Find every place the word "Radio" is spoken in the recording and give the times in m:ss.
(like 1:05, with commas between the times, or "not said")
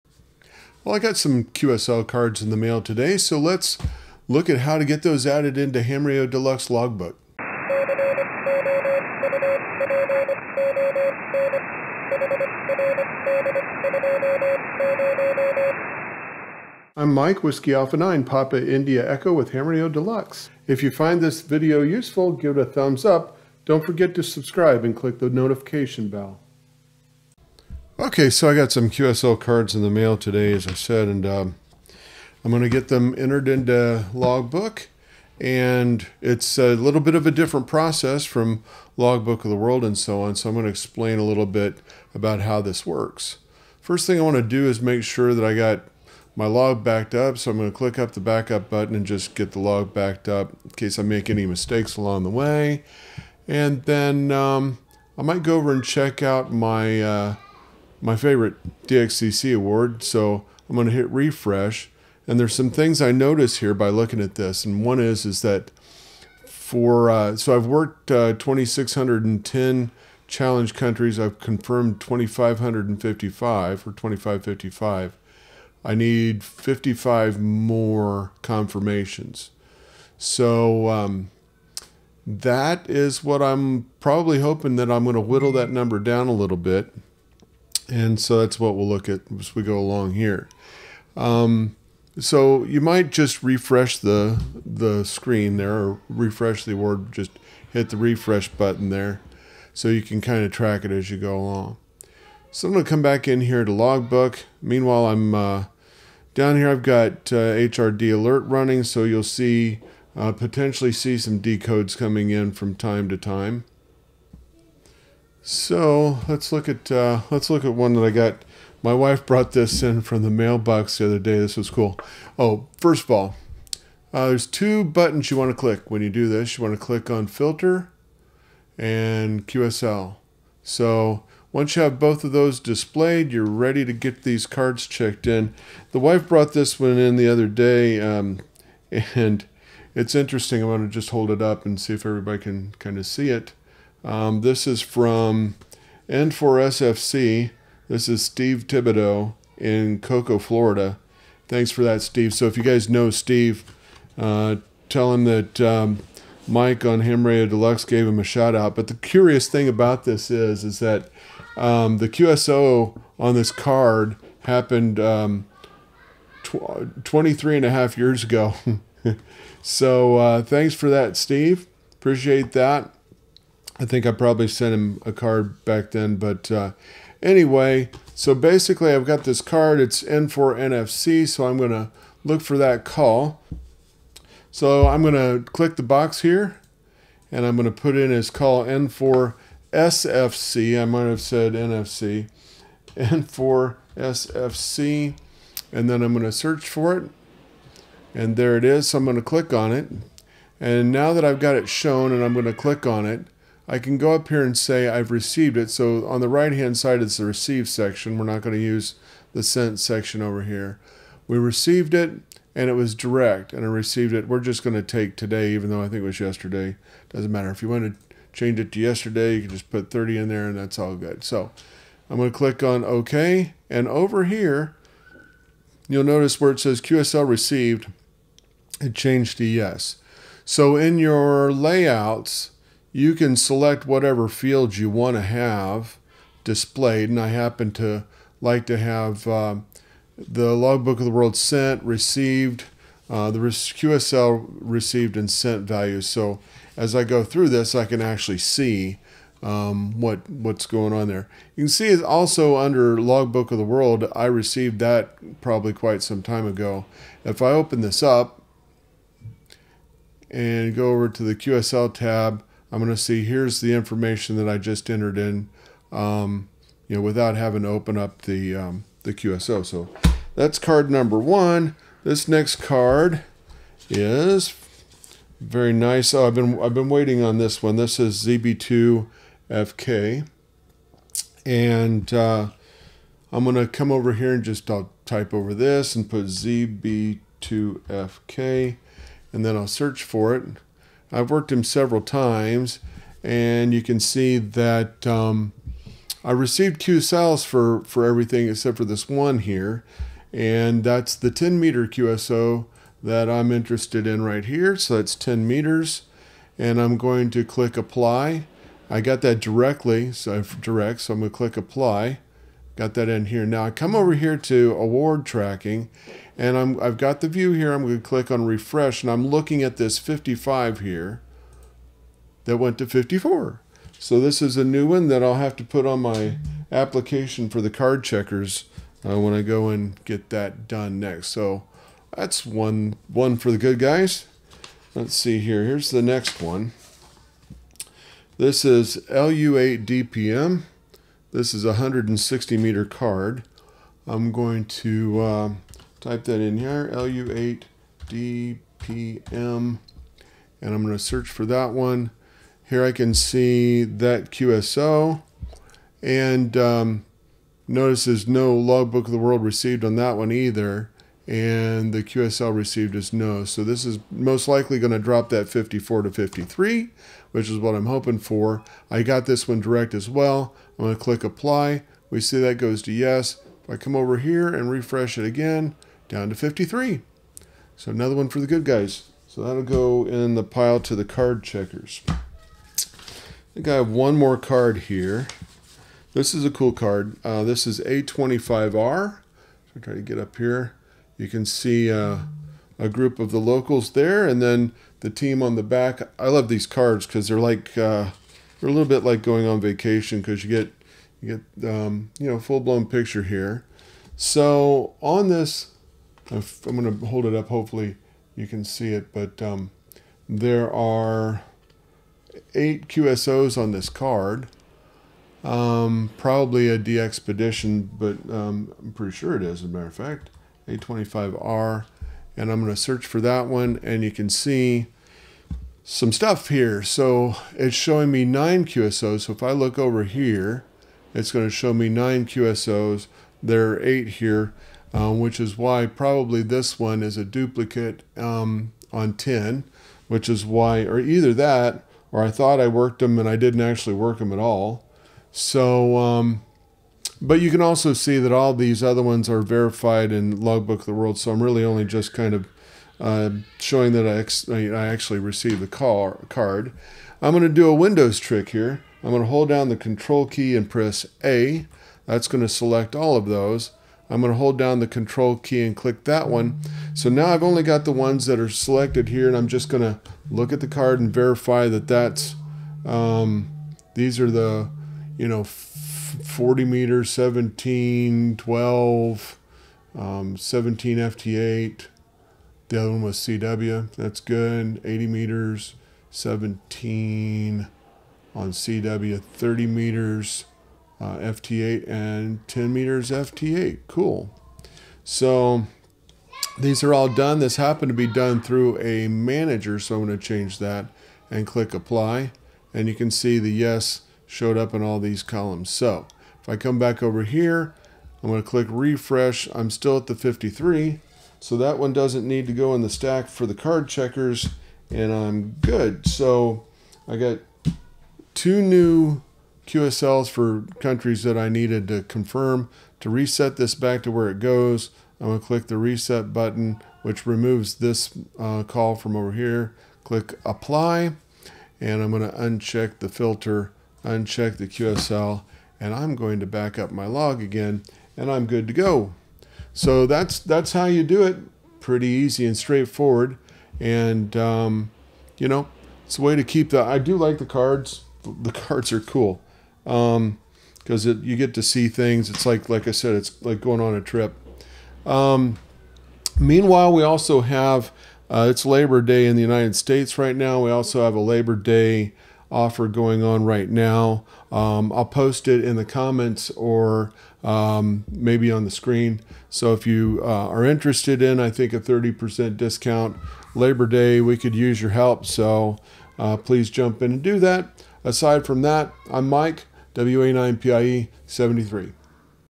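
0:06, 0:19, 2:37.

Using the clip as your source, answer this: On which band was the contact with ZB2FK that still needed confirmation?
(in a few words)
10 meters.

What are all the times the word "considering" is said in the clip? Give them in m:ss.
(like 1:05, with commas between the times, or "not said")
not said.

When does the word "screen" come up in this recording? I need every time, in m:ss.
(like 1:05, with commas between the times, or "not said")
1:35, 9:28.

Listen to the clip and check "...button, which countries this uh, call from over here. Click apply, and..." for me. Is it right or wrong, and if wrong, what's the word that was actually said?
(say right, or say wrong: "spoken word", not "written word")
wrong: "removes", not "countries".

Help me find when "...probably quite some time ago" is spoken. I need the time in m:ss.
4:15.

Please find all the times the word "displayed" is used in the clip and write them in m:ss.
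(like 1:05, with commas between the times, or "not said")
2:12, 3:56.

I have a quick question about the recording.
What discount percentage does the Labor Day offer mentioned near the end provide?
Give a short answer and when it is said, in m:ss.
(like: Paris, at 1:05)
30%, at 9:31.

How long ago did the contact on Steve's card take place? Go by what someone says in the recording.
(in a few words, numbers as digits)
23 and a half years.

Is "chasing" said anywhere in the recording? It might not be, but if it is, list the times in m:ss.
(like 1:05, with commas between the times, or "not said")
not said.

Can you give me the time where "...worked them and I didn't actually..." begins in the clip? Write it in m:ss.
7:22.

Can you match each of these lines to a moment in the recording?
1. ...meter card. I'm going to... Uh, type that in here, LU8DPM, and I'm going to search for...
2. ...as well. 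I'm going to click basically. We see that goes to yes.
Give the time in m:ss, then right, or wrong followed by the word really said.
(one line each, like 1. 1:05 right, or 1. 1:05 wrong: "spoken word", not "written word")
1. 5:42 right
2. 6:09 wrong: "apply", not "basically".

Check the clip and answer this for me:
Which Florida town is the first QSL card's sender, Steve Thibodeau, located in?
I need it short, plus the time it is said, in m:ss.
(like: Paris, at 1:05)
Cocoa, at 2:29.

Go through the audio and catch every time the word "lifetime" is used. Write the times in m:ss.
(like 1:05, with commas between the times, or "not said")
not said.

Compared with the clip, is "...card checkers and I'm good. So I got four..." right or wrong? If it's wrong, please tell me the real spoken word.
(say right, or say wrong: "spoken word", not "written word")
wrong: "two", not "four".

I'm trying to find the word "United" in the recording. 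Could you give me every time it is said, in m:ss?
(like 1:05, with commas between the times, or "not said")
9:19.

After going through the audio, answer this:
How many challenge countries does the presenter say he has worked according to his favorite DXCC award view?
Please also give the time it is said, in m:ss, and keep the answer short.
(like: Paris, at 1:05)
2,610, at 1:08.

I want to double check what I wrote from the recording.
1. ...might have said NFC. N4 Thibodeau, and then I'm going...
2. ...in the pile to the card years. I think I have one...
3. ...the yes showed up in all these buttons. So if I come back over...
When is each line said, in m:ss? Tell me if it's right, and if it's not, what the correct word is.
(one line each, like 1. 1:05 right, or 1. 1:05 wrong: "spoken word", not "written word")
1. 3:10 wrong: "SFC", not "Thibodeau"
2. 6:20 wrong: "checkers", not "years"
3. 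8:23 wrong: "columns", not "buttons".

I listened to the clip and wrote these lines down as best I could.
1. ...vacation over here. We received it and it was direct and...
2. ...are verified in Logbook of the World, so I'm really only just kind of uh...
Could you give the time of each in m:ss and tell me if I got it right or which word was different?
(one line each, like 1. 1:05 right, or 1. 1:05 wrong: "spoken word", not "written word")
1. 3:29 wrong: "section", not "vacation"
2. 7:29 right.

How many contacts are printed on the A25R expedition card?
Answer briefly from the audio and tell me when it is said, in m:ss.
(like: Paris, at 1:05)
8, at 6:52.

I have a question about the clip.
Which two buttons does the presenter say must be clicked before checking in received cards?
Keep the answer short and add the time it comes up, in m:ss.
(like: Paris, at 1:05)
Filter and QSL, at 2:07.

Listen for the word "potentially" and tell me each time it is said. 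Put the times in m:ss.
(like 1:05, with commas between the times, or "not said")
1:50.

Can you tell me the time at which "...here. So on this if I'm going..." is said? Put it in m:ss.
6:43.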